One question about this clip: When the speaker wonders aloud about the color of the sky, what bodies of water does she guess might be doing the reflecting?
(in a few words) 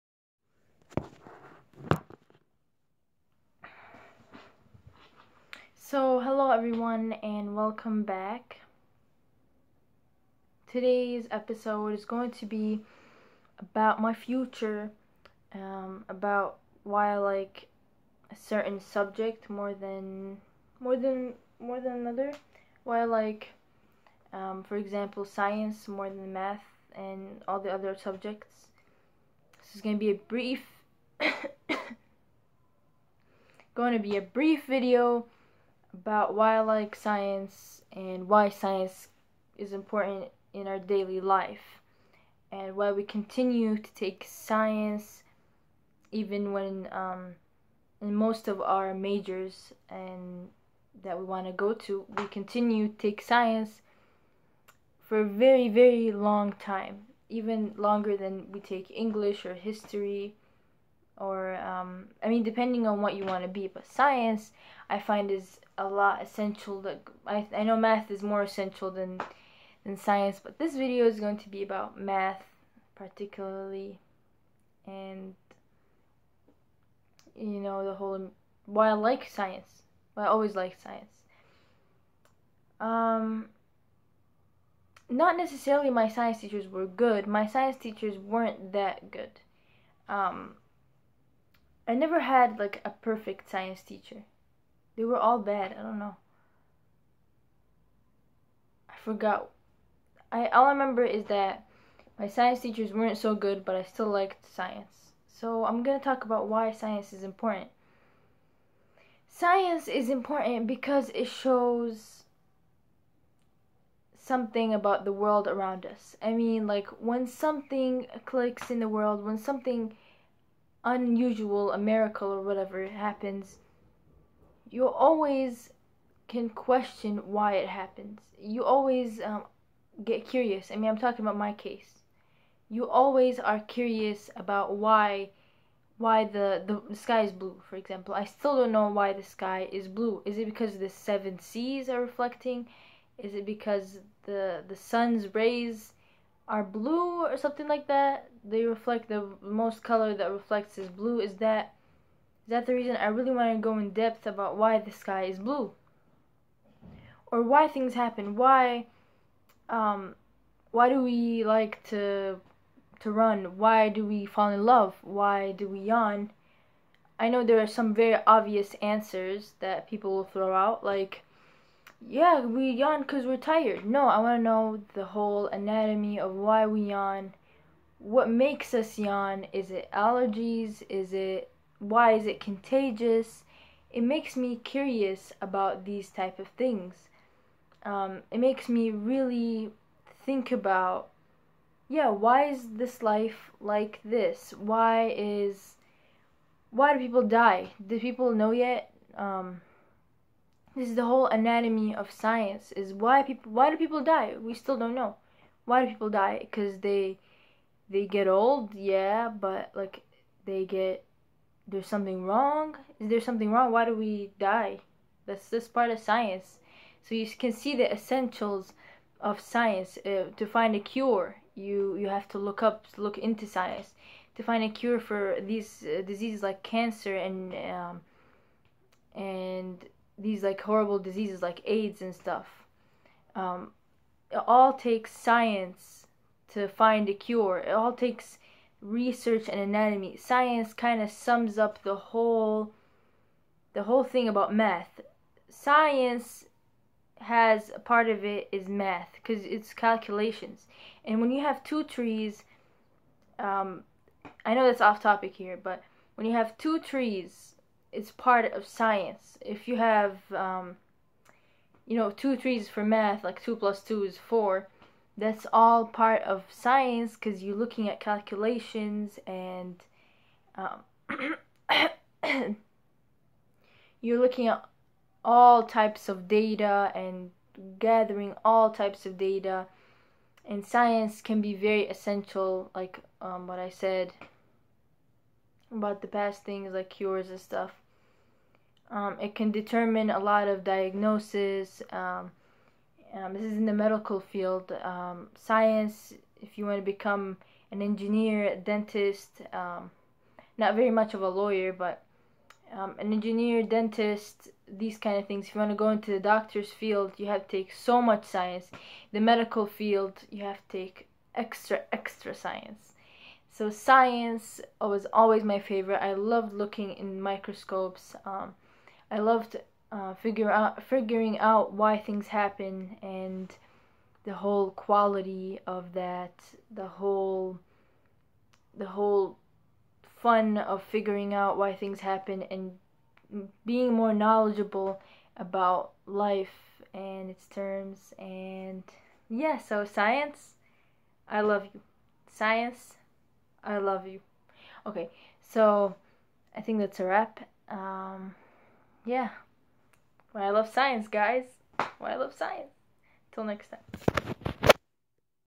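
the seven seas.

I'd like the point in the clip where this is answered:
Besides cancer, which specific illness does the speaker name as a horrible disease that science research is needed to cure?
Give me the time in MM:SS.
03:51.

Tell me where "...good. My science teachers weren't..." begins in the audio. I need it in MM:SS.
01:26.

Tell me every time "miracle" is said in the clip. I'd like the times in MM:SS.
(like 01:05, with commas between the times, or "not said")
02:01.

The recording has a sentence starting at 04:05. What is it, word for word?
Science has a part of it is math because it's calculations.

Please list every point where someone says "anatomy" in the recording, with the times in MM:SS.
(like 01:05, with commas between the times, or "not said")
02:55, 03:21, 03:59.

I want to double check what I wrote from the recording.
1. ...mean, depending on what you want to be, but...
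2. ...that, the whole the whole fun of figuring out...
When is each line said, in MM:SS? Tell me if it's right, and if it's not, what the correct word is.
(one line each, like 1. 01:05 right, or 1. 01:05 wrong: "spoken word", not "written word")
1. 01:02 right
2. 05:25 right.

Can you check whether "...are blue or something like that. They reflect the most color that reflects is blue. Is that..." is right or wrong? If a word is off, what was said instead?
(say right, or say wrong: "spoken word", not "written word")
right.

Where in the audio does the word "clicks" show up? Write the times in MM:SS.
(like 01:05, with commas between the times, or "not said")
01:58.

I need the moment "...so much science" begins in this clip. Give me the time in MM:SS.
05:07.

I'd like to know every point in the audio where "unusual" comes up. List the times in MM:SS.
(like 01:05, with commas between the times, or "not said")
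02:00.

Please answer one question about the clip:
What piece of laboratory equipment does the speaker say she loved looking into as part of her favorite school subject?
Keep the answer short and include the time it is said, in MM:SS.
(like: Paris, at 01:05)
microscopes, at 05:17.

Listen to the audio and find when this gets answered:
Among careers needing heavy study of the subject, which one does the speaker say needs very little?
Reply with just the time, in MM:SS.
05:01.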